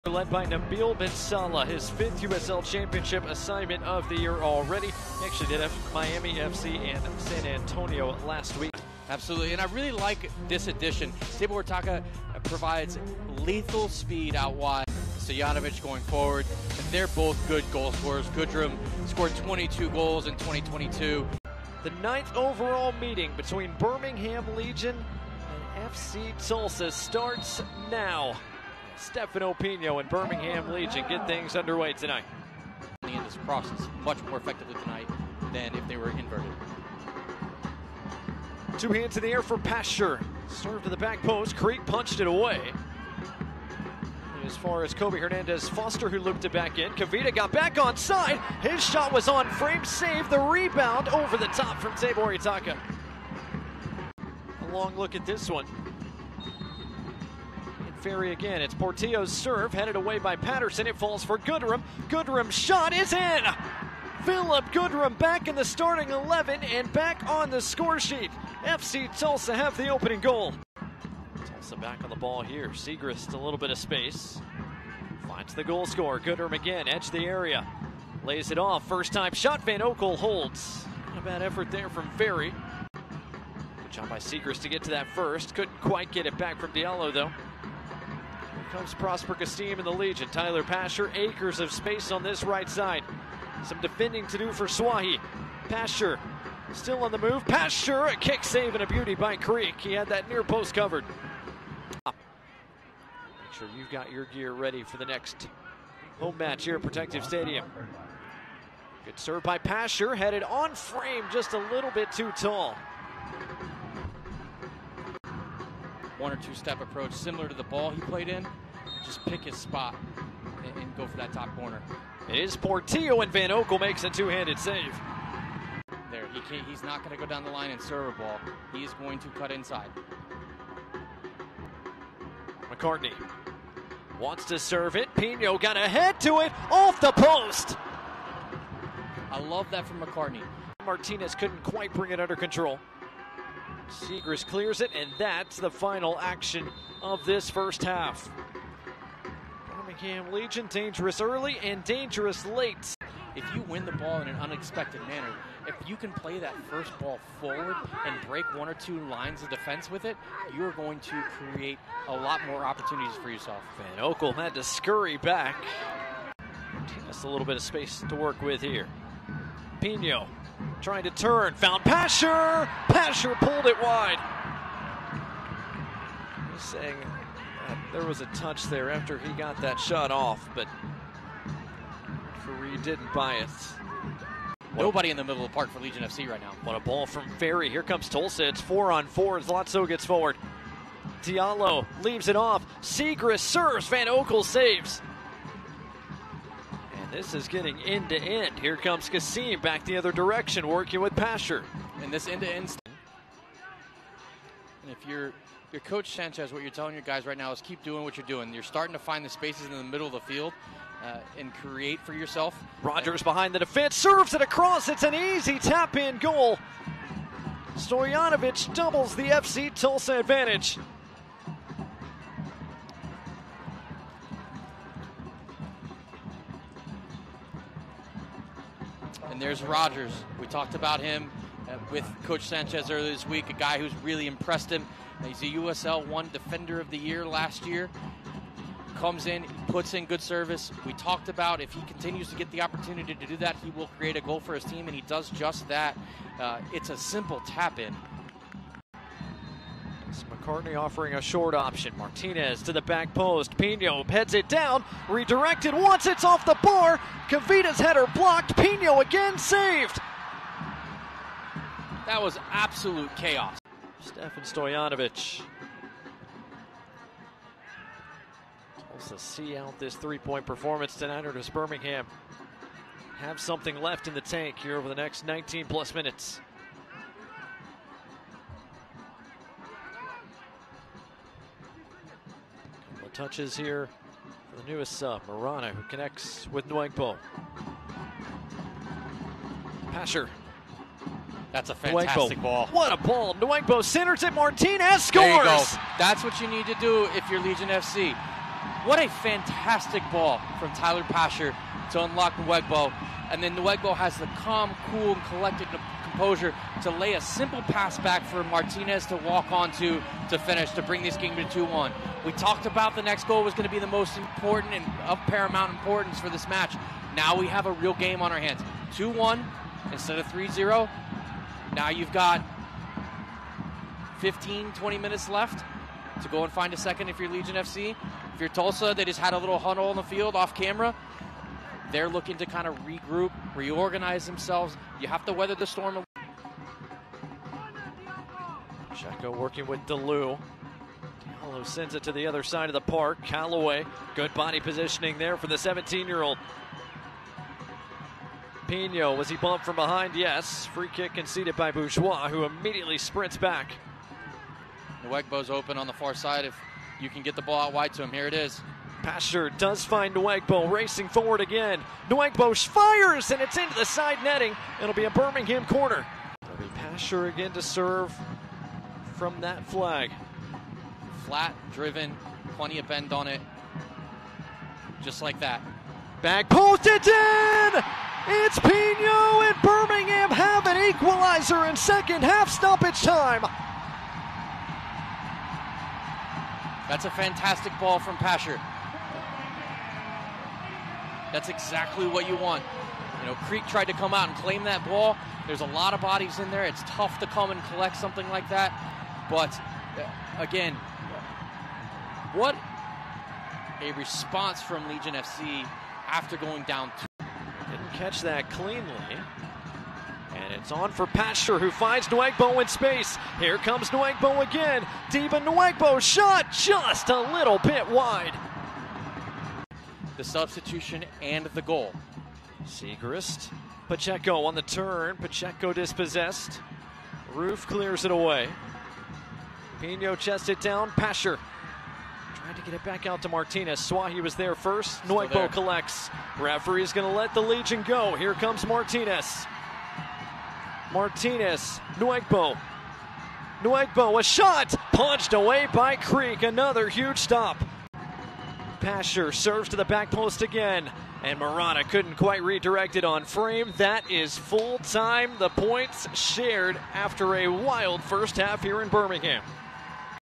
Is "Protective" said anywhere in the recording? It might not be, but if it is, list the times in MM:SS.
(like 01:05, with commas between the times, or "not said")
01:46.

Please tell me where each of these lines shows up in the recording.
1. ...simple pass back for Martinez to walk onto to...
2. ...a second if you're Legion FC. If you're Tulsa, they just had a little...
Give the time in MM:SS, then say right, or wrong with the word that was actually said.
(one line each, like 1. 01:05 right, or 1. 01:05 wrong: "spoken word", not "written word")
1. 05:07 right
2. 05:26 right.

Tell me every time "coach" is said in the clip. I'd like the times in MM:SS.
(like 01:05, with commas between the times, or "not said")
03:25, 03:52.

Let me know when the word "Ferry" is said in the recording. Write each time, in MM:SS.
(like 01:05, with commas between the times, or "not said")
00:58, 01:22, 03:07.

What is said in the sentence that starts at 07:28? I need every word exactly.
Pasher serves to the back post again, and Morana couldn't quite redirect it on frame.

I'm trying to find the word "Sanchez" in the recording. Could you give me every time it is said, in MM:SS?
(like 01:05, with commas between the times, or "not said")
03:26, 03:52.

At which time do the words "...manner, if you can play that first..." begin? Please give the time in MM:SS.
02:35.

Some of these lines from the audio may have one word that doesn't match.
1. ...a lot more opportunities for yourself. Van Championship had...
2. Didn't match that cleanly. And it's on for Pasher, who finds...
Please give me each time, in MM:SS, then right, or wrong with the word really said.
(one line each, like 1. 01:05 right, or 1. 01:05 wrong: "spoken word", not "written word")
1. 02:42 wrong: "Oekel", not "Championship"
2. 06:47 wrong: "catch", not "match".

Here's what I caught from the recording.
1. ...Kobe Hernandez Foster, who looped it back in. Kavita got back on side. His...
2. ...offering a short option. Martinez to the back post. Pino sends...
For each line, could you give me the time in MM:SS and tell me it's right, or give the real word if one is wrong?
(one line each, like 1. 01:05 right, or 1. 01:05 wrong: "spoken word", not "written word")
1. 00:44 right
2. 04:10 wrong: "heads", not "sends".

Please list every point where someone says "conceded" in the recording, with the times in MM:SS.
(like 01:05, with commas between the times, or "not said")
05:51.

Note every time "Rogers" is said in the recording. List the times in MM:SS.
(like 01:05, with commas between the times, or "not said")
03:32, 03:49.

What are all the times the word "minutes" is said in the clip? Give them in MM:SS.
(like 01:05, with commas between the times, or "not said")
04:35, 05:24.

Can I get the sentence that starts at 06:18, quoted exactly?
It's Pino and Birmingham have an equalizer in second half stoppage time.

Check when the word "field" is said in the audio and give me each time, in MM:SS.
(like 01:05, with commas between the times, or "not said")
03:30, 05:30.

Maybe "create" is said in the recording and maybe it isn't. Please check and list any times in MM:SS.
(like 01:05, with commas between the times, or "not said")
02:41, 03:31, 04:03.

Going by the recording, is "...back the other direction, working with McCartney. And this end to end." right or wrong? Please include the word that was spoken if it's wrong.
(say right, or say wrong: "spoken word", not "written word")
wrong: "Pasher", not "McCartney".